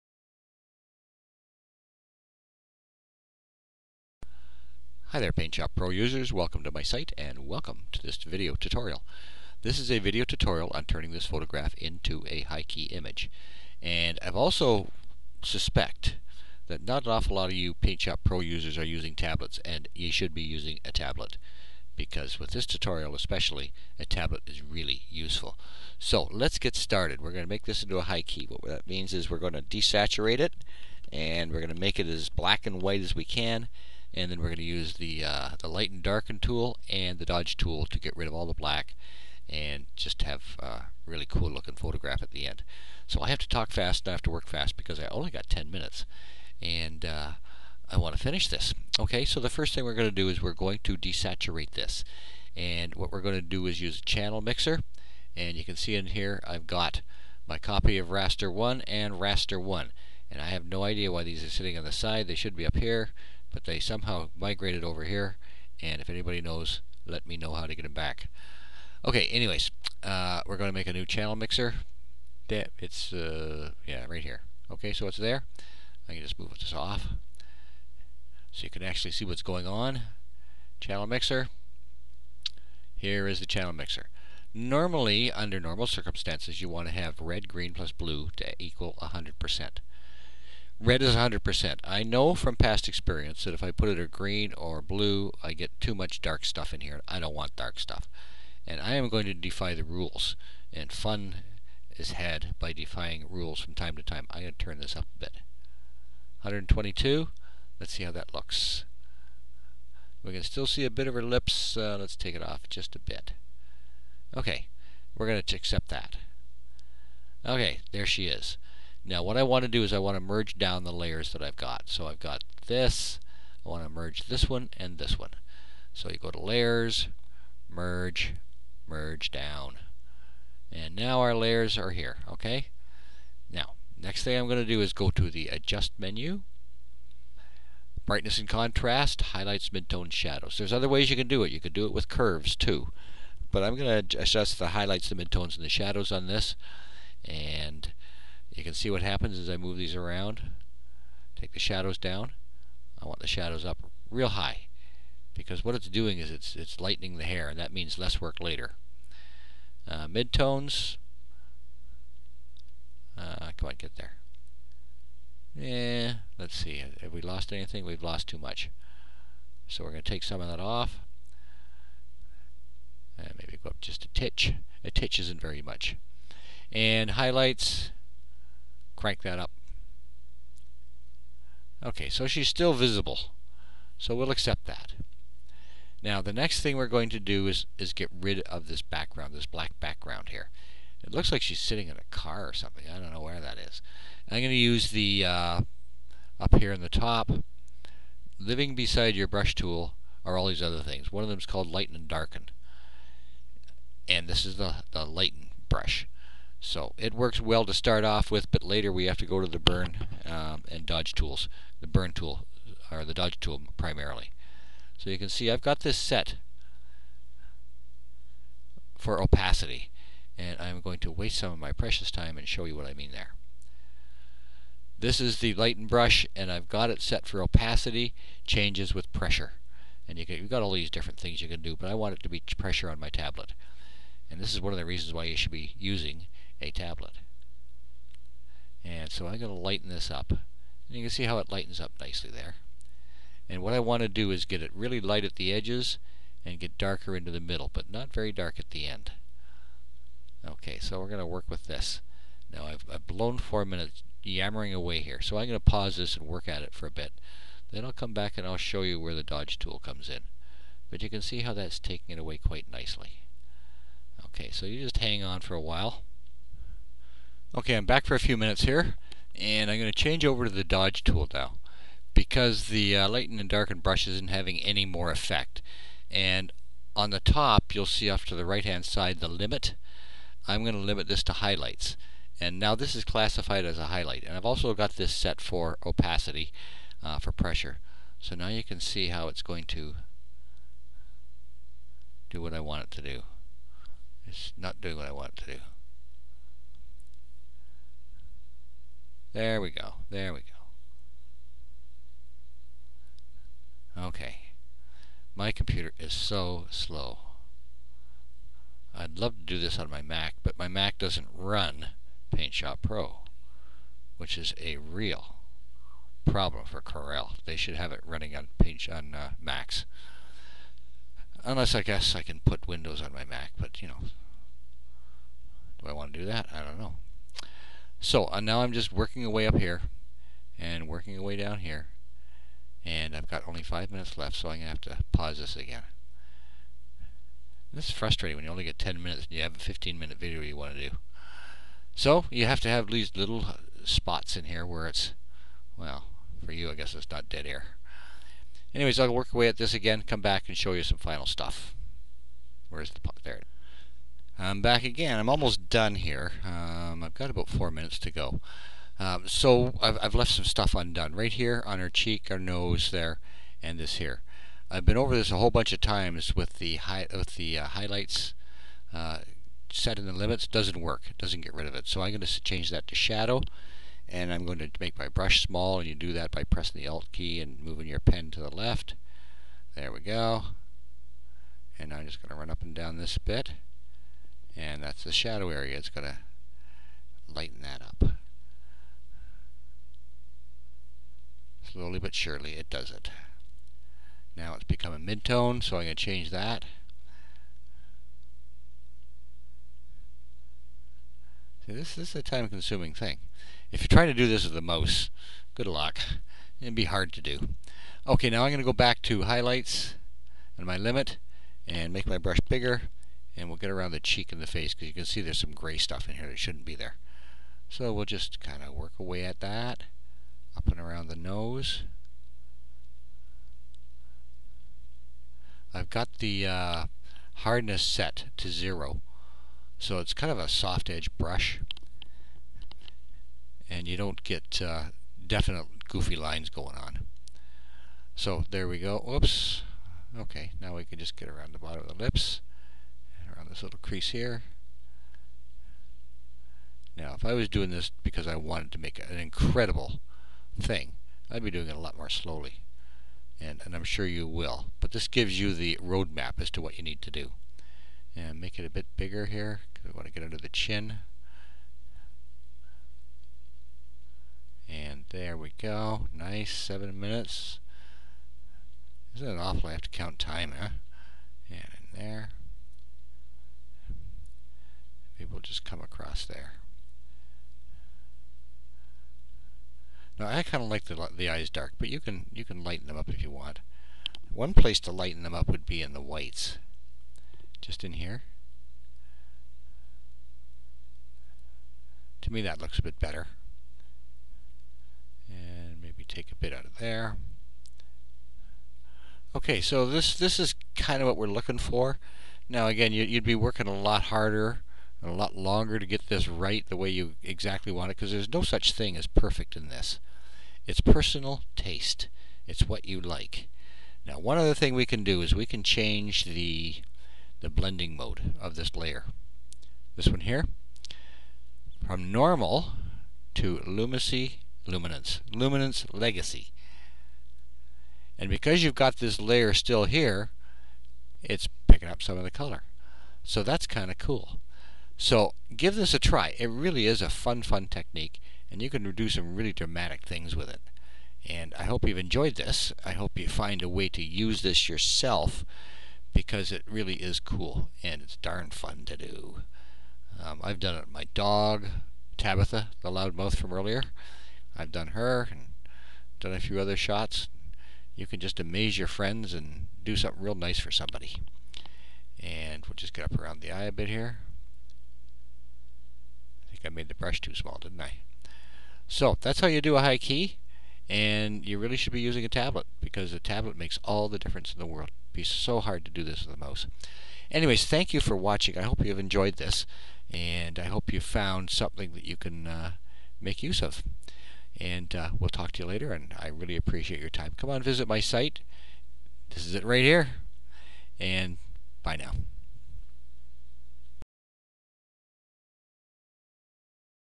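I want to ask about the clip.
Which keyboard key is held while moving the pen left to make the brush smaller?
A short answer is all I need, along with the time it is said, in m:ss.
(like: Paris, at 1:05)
Alt, at 6:16.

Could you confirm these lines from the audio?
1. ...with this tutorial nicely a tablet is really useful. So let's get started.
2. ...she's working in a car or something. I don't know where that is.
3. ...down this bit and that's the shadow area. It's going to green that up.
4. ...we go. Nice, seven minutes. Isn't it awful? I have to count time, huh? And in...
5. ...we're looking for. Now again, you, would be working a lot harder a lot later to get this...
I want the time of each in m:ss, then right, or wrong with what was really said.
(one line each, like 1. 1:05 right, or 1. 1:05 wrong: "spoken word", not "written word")
1. 0:22 wrong: "especially", not "nicely"
2. 3:11 wrong: "sitting", not "working"
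3. 6:22 wrong: "lighten", not "green"
4. 7:45 right
5. 8:21 wrong: "longer", not "later".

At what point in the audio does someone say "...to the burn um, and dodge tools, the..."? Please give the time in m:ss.
3:29.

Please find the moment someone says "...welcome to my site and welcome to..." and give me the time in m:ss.
0:06.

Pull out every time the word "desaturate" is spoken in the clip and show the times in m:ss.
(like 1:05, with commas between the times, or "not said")
0:29, 0:50.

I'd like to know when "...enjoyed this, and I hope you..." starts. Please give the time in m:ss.
9:38.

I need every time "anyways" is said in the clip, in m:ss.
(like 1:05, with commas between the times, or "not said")
1:09, 5:48, 9:37.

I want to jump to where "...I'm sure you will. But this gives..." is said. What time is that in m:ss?
7:33.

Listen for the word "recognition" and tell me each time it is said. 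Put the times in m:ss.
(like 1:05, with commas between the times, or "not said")
not said.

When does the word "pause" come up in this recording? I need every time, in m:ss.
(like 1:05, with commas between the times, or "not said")
4:15, 5:35.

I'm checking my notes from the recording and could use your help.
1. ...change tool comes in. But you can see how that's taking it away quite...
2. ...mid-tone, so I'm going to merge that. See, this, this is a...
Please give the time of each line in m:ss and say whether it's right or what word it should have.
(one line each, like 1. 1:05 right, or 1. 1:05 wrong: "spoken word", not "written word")
1. 4:19 wrong: "dodge", not "change"
2. 6:34 wrong: "change", not "merge".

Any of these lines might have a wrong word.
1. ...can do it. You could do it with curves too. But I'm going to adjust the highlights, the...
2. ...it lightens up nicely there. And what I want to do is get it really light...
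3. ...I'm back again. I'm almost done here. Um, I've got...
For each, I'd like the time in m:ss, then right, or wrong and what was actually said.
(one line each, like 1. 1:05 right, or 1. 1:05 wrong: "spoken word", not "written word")
1. 2:21 right
2. 4:01 right
3. 5:54 right.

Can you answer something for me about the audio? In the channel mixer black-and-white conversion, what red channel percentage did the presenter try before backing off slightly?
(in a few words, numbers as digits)
122.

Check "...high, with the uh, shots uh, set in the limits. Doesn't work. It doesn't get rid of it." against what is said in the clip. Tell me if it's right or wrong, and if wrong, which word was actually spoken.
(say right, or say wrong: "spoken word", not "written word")
wrong: "highlights", not "shots".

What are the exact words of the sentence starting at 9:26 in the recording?
I made the brush too small, didn't I?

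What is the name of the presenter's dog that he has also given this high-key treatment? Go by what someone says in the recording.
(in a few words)
Tabitha.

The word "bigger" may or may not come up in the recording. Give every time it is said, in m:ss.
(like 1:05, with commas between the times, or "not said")
6:52, 7:38.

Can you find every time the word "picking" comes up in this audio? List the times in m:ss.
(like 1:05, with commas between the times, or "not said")
8:51.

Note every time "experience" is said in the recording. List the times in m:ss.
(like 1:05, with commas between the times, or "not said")
1:32.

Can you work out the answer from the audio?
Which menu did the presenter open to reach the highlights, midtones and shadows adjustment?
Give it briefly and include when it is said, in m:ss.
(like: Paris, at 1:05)
adjust menu, at 2:15.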